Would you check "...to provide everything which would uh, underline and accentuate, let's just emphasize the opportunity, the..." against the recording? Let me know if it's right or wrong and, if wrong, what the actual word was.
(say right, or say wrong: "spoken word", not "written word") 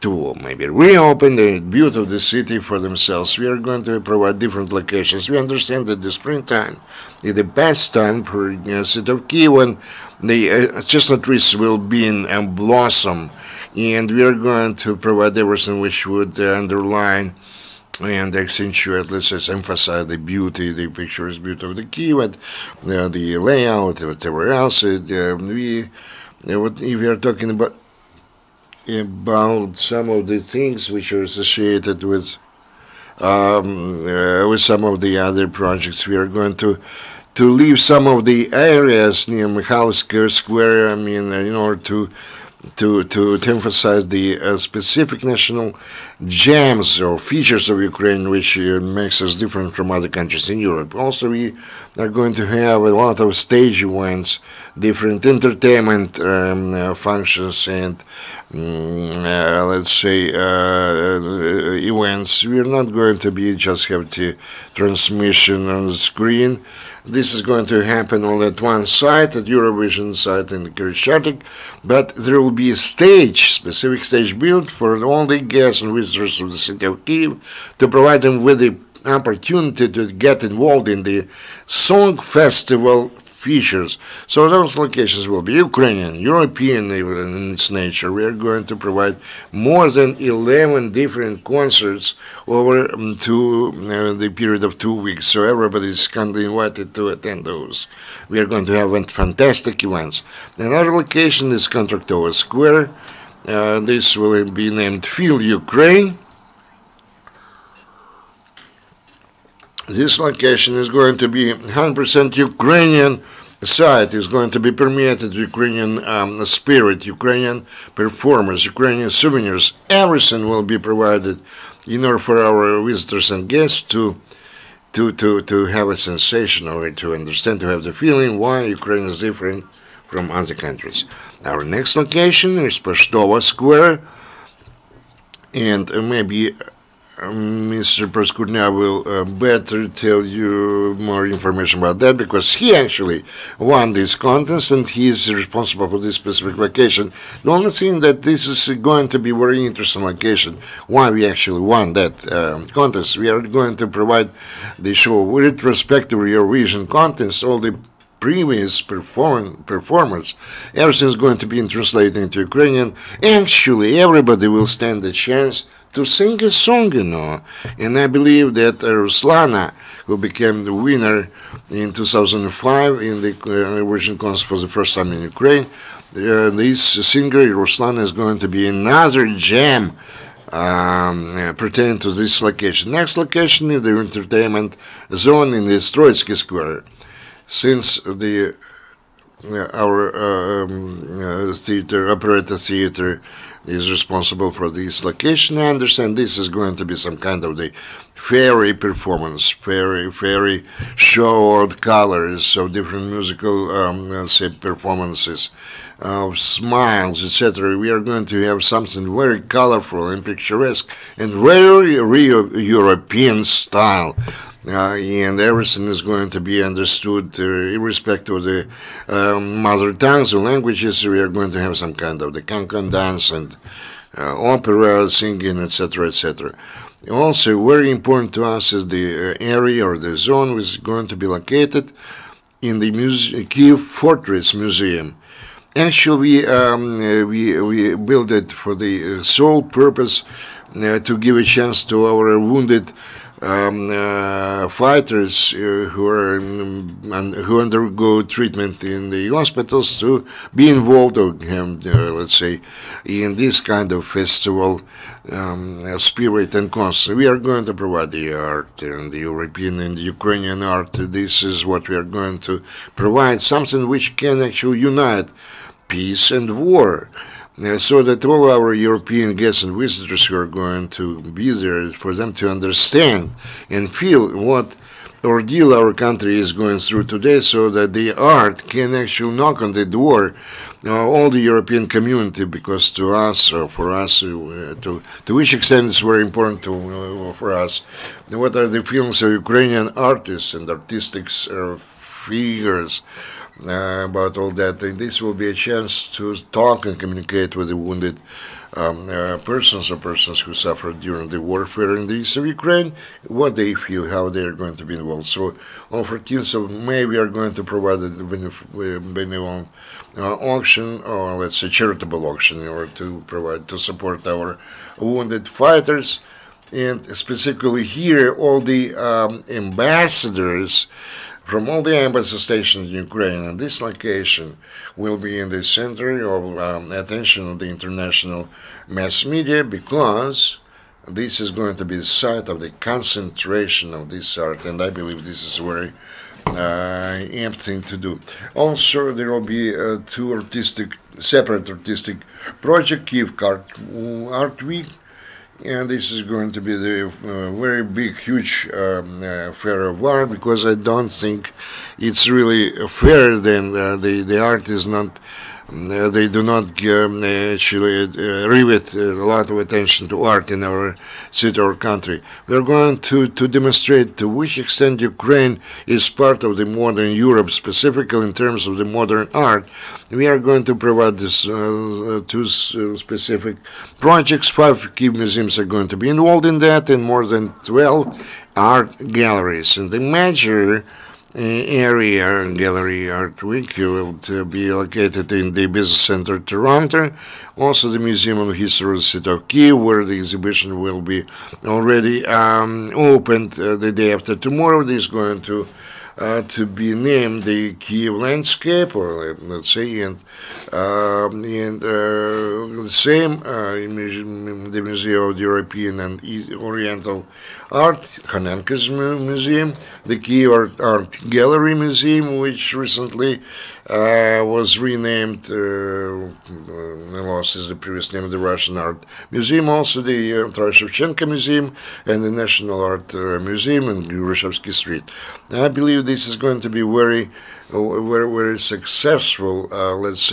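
wrong: "beauty", not "opportunity".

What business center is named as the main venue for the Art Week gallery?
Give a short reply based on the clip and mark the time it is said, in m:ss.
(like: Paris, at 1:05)
Toronto, at 6:26.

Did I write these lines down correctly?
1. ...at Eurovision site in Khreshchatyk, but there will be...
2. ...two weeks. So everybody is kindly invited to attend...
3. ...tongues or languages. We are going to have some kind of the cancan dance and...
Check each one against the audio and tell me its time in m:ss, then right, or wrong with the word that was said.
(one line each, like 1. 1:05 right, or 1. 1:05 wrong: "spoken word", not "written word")
1. 1:09 right
2. 1:34 right
3. 3:39 right.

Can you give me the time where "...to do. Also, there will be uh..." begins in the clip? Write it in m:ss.
5:37.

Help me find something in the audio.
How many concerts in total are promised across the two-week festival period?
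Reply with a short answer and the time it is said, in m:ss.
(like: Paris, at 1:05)
More than 11, at 1:29.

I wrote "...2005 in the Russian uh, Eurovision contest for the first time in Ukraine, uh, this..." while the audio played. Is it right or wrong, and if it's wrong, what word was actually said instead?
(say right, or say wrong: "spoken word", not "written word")
right.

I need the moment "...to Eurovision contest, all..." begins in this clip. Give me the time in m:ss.
2:36.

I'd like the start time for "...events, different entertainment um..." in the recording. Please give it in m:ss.
0:53.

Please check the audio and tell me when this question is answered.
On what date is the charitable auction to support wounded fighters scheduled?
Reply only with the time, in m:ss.
5:06.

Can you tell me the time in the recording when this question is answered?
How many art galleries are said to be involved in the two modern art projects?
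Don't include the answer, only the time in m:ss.
6:17.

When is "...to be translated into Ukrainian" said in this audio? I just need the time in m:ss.
2:41.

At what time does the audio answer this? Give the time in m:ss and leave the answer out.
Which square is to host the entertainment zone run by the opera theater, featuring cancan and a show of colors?
3:05.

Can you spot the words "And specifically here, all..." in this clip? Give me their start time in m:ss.
5:16.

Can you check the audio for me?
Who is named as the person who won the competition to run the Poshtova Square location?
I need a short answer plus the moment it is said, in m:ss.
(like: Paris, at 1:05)
Proskurnia, at 2:18.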